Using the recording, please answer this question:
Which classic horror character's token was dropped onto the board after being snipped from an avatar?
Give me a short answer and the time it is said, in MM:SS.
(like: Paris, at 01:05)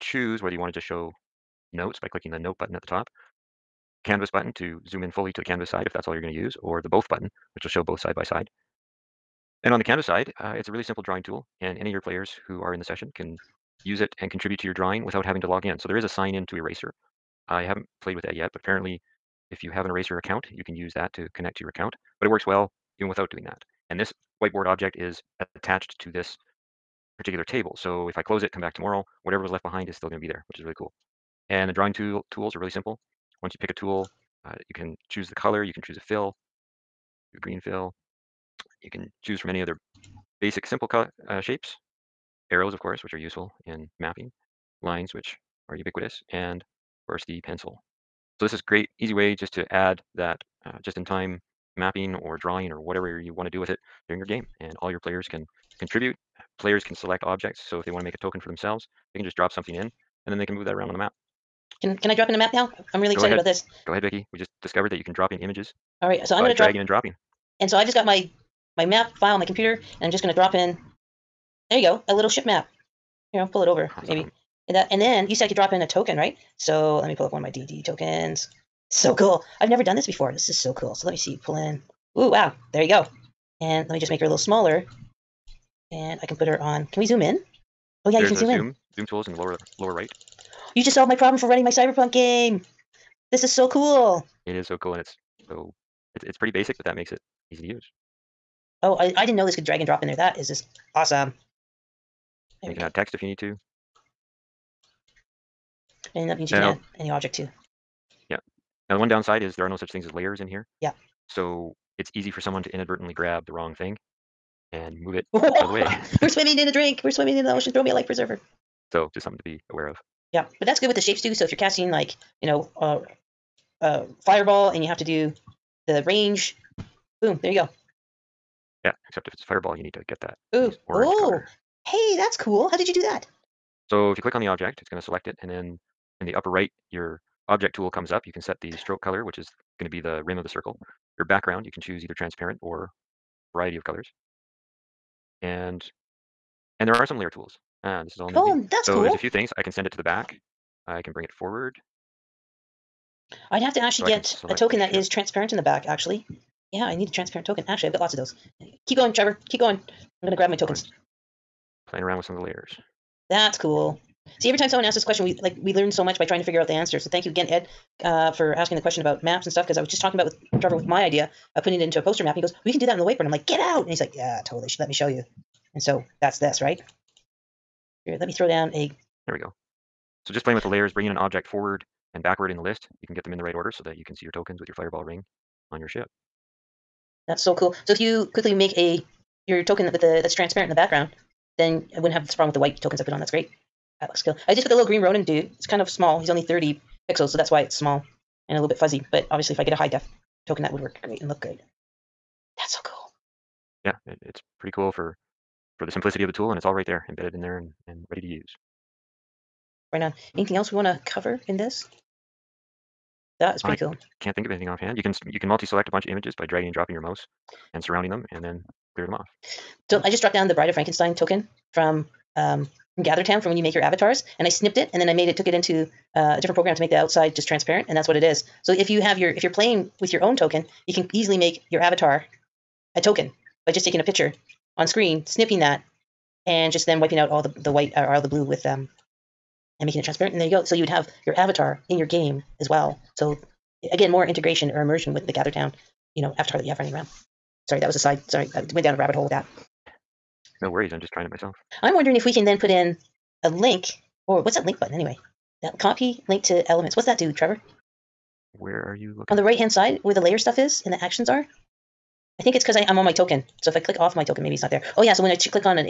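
Bride of Frankenstein, at 03:40.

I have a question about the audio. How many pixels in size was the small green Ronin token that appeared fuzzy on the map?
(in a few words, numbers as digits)
30.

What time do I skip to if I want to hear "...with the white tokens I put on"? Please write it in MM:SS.
03:12.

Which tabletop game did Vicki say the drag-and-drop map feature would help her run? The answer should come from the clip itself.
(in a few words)
Cyberpunk.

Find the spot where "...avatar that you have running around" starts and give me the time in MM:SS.
04:06.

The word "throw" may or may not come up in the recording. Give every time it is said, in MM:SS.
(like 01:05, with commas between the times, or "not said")
01:57, 02:58.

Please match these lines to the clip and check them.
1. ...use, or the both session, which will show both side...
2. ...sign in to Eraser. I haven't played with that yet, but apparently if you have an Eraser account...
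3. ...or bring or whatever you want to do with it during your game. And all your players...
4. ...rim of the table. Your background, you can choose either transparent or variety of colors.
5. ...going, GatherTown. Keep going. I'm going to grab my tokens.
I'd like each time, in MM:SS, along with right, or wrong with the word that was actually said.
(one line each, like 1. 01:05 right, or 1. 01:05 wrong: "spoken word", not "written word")
1. 00:06 wrong: "button", not "session"
2. 00:16 right
3. 00:52 wrong: "drawing", not "bring"
4. 02:20 wrong: "circle", not "table"
5. 02:38 wrong: "Trevor", not "GatherTown".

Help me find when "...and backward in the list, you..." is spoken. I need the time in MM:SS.
03:02.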